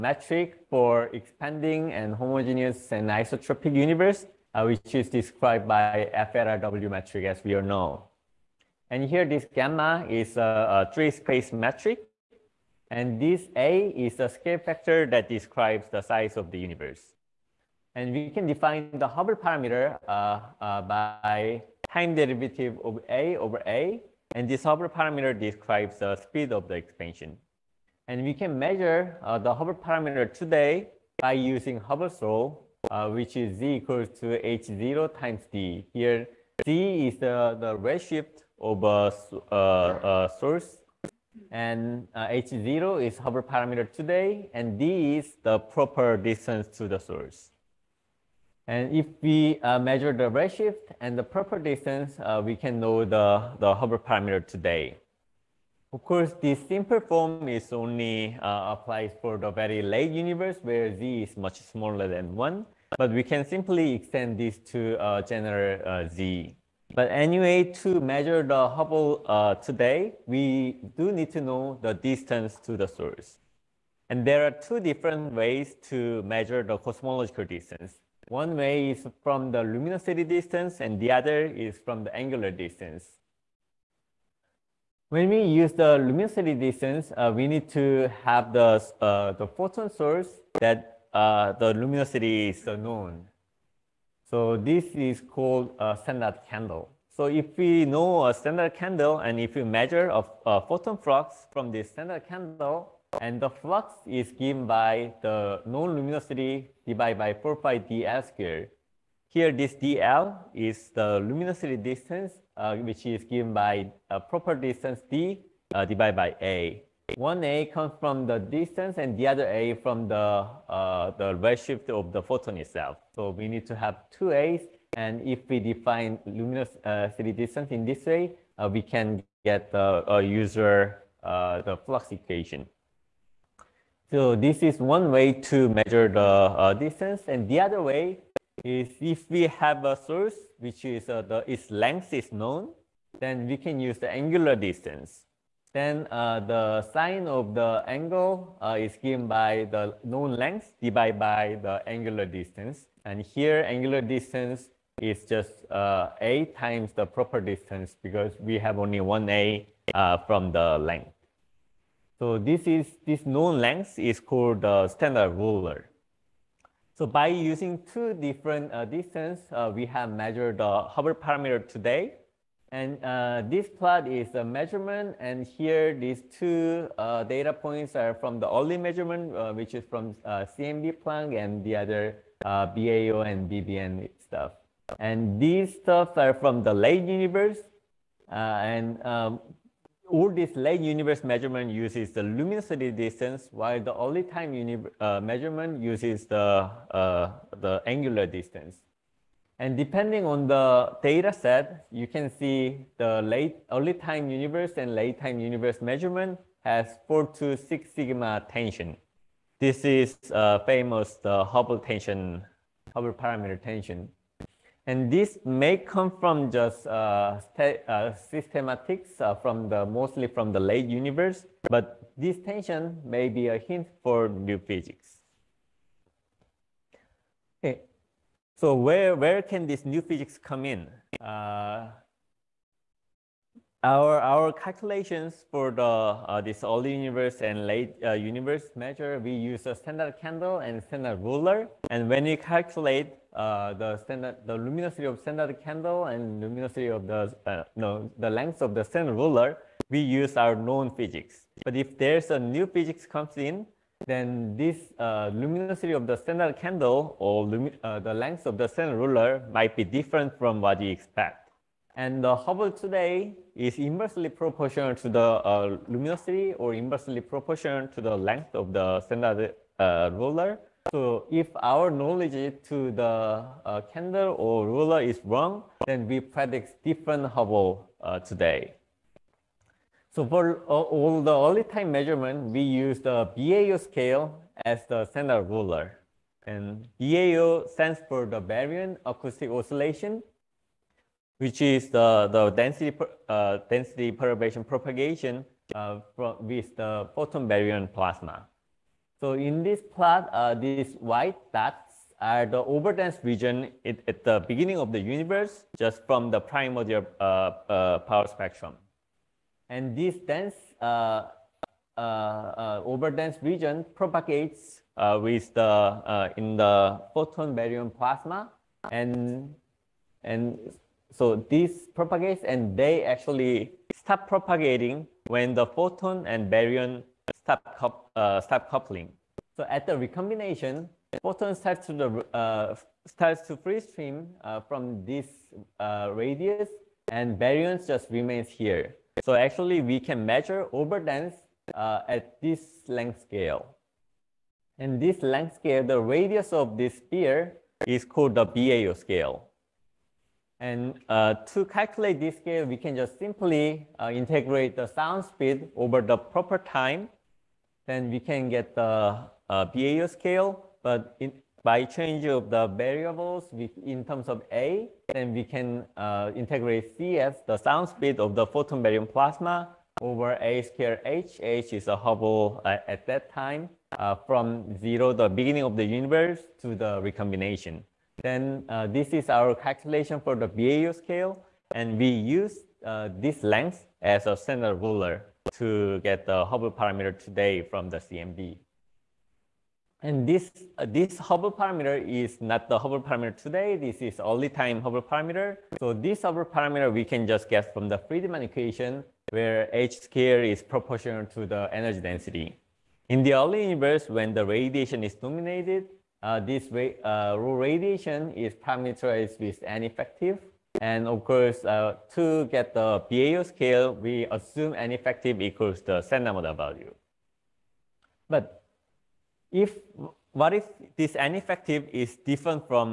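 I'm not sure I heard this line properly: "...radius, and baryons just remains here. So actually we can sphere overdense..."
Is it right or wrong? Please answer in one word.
wrong.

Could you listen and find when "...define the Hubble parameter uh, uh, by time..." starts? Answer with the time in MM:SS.
00:18.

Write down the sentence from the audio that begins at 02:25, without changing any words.
Then uh, the sine of the angle uh, is given by the known length divided by the angular distance.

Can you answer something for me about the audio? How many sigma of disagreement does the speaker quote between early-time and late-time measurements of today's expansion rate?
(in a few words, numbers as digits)
4 to 6 sigma.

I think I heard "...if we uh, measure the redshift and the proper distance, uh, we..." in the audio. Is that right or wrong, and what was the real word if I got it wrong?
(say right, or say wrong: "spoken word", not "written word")
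right.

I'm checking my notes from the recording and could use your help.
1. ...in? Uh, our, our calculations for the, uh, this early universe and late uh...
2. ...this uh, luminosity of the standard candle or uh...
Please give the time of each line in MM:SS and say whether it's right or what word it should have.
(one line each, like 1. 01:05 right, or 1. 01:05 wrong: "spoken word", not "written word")
1. 03:50 right
2. 04:14 right.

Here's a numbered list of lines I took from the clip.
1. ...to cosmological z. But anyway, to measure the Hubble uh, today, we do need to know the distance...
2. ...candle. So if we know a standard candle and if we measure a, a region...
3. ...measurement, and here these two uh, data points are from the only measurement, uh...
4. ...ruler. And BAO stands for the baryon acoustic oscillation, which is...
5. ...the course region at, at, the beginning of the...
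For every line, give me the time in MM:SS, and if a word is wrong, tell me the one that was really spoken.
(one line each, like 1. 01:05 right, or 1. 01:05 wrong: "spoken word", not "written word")
1. 01:04 wrong: "general", not "cosmological"
2. 01:36 wrong: "photon", not "region"
3. 02:54 right
4. 04:45 right
5. 05:02 wrong: "overdense", not "course".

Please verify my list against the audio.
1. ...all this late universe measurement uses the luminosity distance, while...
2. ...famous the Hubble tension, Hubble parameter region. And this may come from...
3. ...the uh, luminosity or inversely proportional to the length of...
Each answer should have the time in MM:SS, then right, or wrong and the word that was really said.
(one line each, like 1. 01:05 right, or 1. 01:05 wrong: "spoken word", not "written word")
1. 03:10 right
2. 03:30 wrong: "tension", not "region"
3. 04:25 right.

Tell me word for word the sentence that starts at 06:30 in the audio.
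And this, uh, this Hubble parameter is not the Hubble parameter today.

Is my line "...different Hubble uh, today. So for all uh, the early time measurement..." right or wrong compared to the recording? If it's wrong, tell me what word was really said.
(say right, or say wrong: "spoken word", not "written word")
right.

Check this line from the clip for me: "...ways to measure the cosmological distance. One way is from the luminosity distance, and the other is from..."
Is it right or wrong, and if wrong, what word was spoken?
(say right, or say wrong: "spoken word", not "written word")
right.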